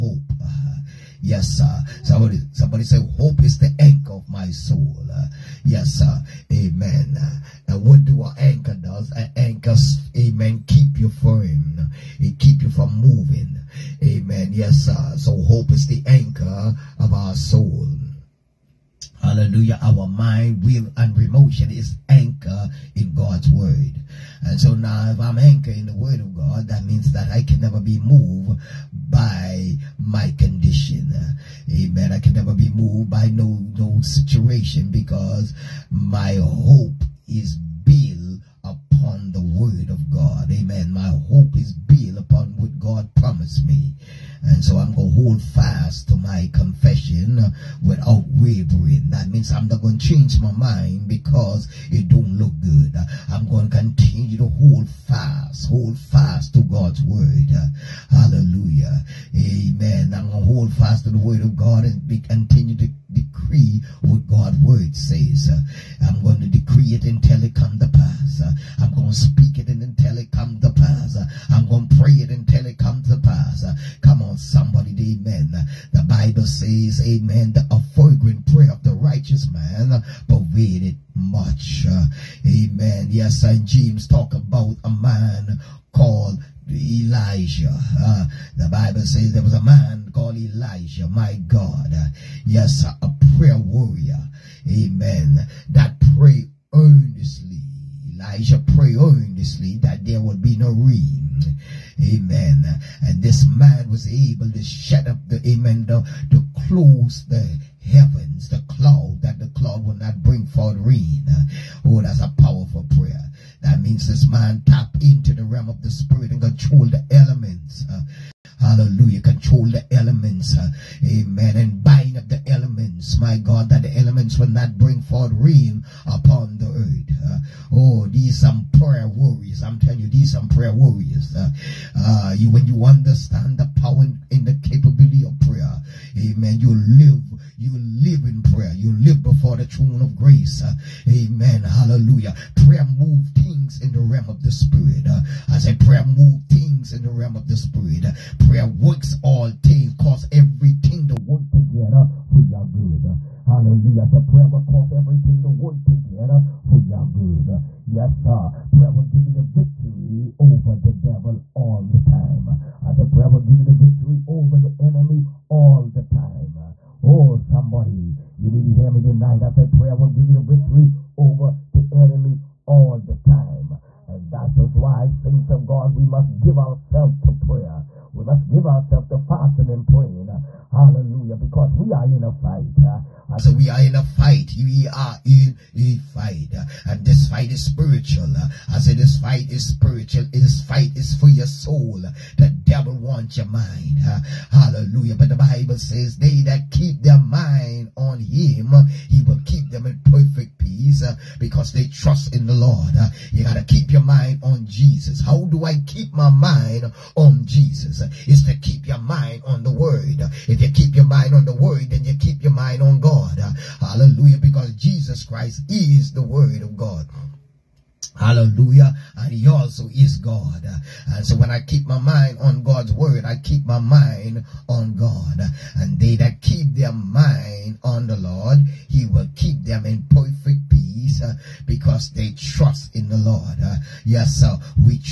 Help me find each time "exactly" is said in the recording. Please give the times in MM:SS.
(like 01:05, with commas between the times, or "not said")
not said.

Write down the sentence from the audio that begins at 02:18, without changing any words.
You live before the throne of grace.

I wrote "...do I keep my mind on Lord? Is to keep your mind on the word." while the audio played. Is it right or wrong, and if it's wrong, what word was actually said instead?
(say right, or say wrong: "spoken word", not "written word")
wrong: "Jesus", not "Lord".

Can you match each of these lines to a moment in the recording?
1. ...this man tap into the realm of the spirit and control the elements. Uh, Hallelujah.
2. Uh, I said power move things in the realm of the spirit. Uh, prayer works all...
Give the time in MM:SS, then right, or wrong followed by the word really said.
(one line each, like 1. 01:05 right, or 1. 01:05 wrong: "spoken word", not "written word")
1. 01:54 right
2. 02:25 wrong: "prayer", not "power".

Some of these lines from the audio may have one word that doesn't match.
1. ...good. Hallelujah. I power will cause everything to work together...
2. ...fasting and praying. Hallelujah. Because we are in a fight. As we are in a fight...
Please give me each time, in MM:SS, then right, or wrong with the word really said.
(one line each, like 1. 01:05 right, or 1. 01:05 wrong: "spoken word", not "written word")
1. 02:32 wrong: "prayer", not "power"
2. 02:59 right.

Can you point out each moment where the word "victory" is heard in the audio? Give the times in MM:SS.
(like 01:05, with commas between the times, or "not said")
02:39, 02:43, 02:50.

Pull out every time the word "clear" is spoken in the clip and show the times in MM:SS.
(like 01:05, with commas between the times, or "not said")
not said.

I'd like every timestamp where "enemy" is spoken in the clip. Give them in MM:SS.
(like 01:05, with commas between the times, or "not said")
02:44, 02:51.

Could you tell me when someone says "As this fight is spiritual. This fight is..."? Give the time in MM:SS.
03:08.